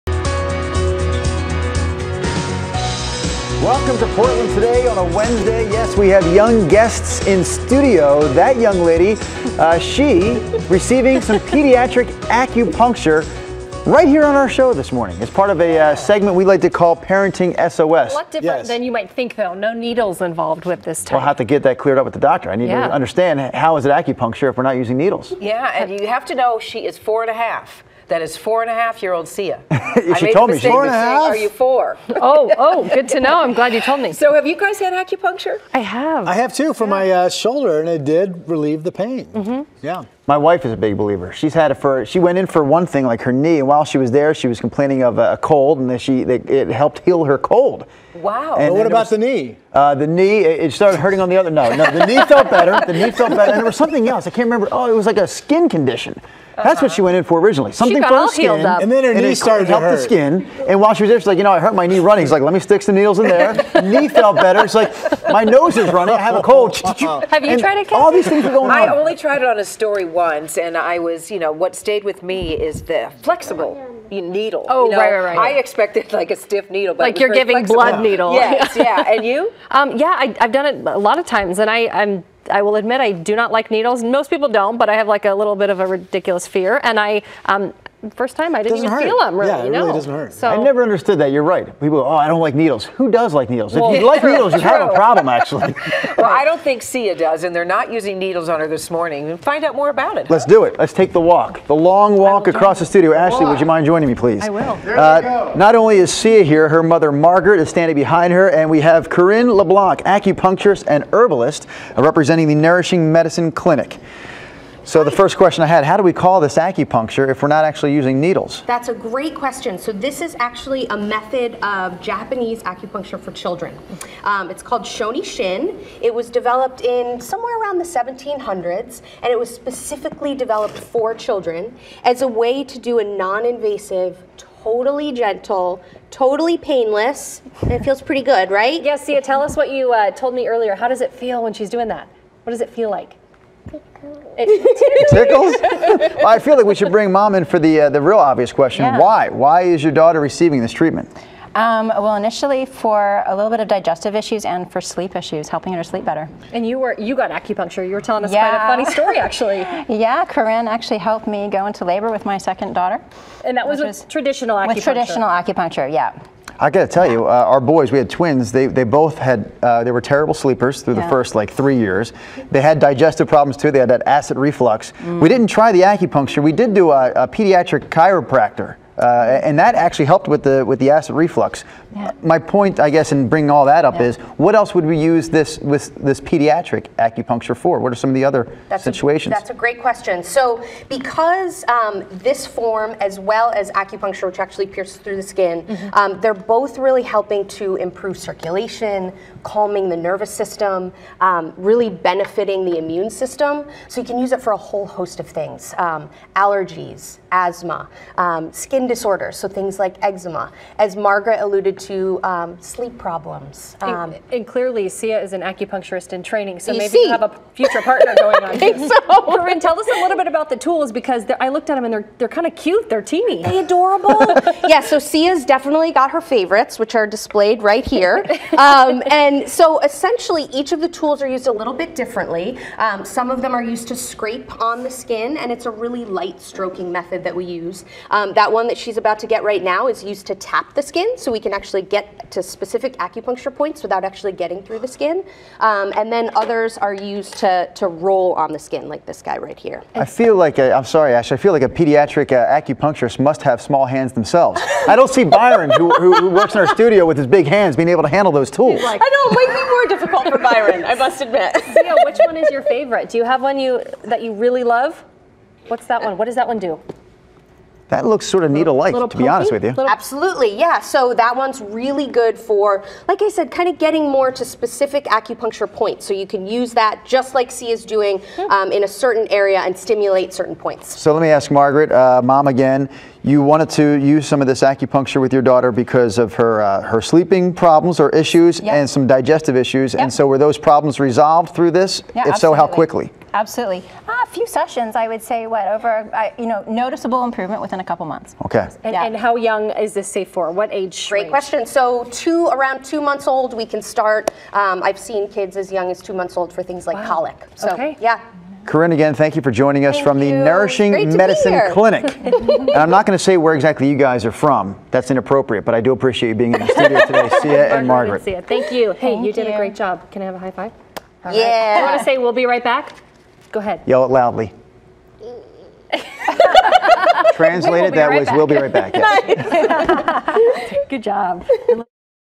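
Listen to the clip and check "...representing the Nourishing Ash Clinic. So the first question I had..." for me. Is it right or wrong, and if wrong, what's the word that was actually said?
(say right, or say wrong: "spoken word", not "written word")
wrong: "Medicine", not "Ash".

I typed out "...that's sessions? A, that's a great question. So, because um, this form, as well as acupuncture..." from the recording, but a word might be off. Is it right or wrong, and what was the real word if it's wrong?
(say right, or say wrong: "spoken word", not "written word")
wrong: "situations", not "sessions".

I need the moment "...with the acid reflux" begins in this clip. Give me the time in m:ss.
3:00.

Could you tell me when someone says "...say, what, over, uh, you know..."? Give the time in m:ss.
4:55.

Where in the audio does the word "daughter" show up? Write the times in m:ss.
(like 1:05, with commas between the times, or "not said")
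2:29, 2:42, 4:45.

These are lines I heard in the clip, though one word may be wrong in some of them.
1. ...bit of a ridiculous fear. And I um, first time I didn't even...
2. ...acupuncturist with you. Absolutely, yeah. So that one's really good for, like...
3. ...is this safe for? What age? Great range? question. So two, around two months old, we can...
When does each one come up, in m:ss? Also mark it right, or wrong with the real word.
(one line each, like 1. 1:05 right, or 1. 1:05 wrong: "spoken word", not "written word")
1. 1:25 right
2. 4:29 wrong: "honest", not "acupuncturist"
3. 4:59 right.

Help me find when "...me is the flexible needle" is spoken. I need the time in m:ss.
1:12.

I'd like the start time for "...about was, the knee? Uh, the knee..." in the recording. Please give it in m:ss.
0:48.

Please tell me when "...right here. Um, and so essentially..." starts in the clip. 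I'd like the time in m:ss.
3:47.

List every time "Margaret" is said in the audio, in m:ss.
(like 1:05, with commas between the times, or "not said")
1:47, 3:30, 4:41, 5:17.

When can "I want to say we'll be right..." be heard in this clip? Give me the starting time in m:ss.
5:21.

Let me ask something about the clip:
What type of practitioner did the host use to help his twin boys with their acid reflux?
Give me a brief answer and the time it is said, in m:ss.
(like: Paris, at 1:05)
Pediatric chiropractor, at 2:57.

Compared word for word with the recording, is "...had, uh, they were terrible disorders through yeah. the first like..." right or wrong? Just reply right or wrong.
wrong.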